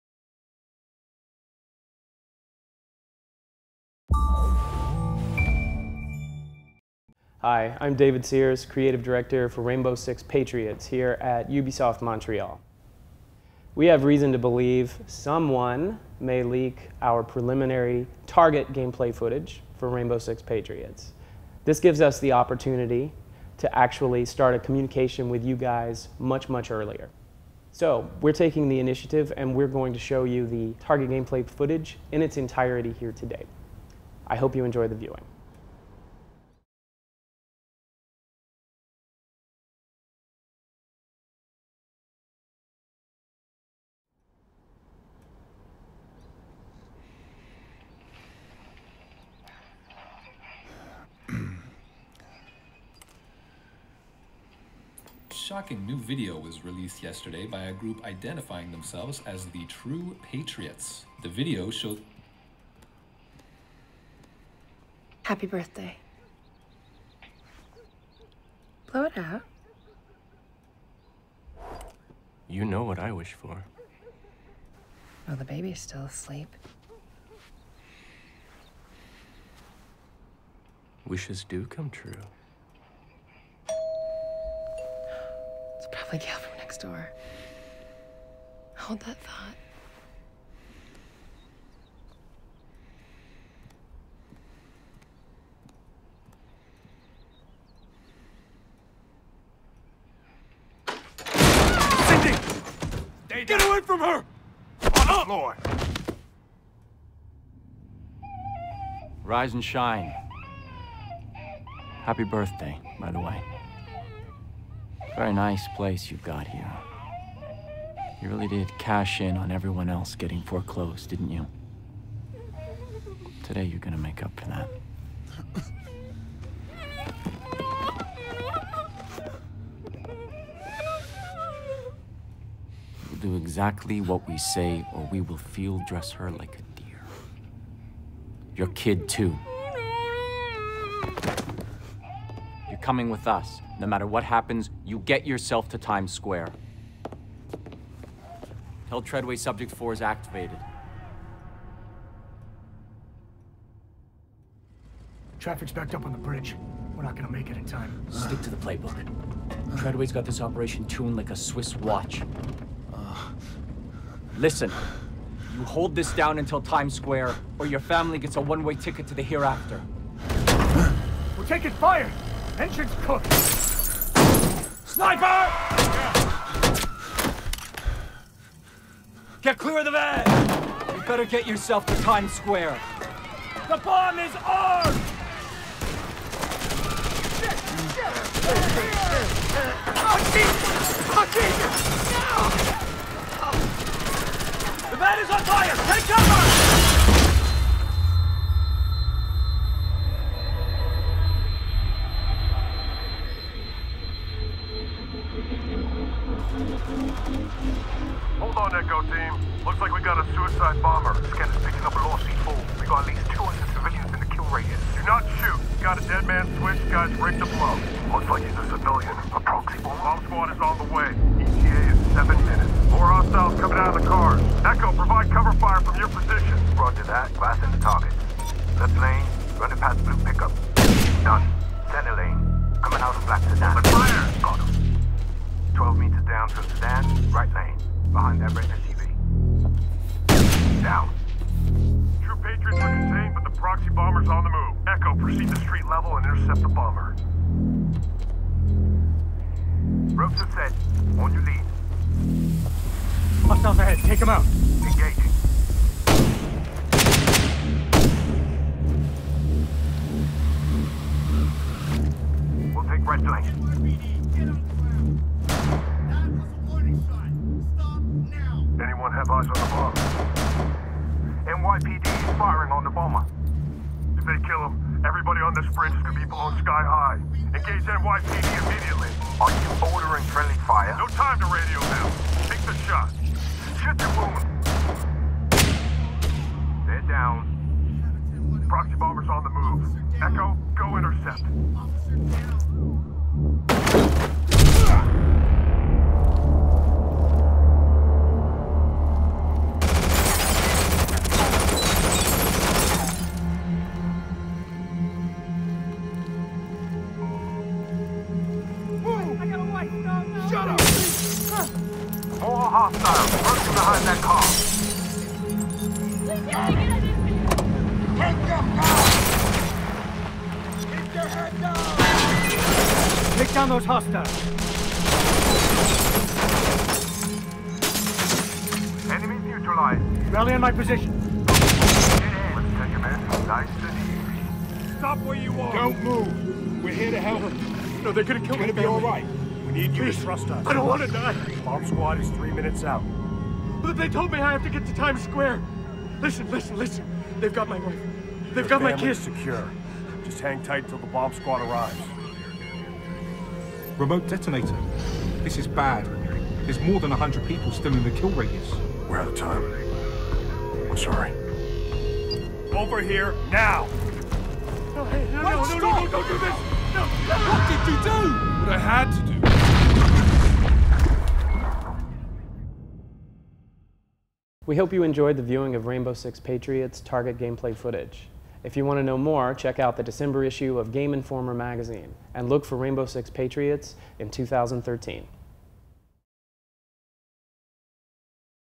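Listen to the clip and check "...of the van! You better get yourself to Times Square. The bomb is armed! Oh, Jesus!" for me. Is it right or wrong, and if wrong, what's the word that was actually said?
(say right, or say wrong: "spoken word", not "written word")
right.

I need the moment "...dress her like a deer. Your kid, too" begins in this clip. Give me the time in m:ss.
2:15.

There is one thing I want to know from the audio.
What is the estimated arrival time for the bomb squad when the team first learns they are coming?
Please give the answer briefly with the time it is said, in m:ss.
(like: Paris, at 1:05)
7 minutes, at 3:42.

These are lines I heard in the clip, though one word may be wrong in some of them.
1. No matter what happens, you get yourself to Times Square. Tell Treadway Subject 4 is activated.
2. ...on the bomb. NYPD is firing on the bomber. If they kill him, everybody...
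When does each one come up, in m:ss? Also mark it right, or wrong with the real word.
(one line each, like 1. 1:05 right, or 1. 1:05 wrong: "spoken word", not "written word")
1. 2:23 right
2. 4:29 right.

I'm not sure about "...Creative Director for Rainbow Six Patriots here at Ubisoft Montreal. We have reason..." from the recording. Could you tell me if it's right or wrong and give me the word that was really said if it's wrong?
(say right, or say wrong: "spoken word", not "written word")
right.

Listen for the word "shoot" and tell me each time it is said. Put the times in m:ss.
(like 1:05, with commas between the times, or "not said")
3:35, 4:43.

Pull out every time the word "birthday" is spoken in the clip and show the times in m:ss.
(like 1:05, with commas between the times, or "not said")
1:05, 1:52.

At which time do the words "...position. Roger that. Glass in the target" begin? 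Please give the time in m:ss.
3:46.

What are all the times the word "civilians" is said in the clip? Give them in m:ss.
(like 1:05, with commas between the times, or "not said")
3:33, 3:38.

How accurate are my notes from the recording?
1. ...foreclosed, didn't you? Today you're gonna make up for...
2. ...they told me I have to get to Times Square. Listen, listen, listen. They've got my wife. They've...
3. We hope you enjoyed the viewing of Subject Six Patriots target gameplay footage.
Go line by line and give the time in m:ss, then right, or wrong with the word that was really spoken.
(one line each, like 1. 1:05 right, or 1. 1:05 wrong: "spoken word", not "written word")
1. 2:00 right
2. 5:43 right
3. 6:14 wrong: "Rainbow", not "Subject".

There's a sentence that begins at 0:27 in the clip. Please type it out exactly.
So we're taking the initiative and we're going to show you the target gameplay footage in its entirety here today.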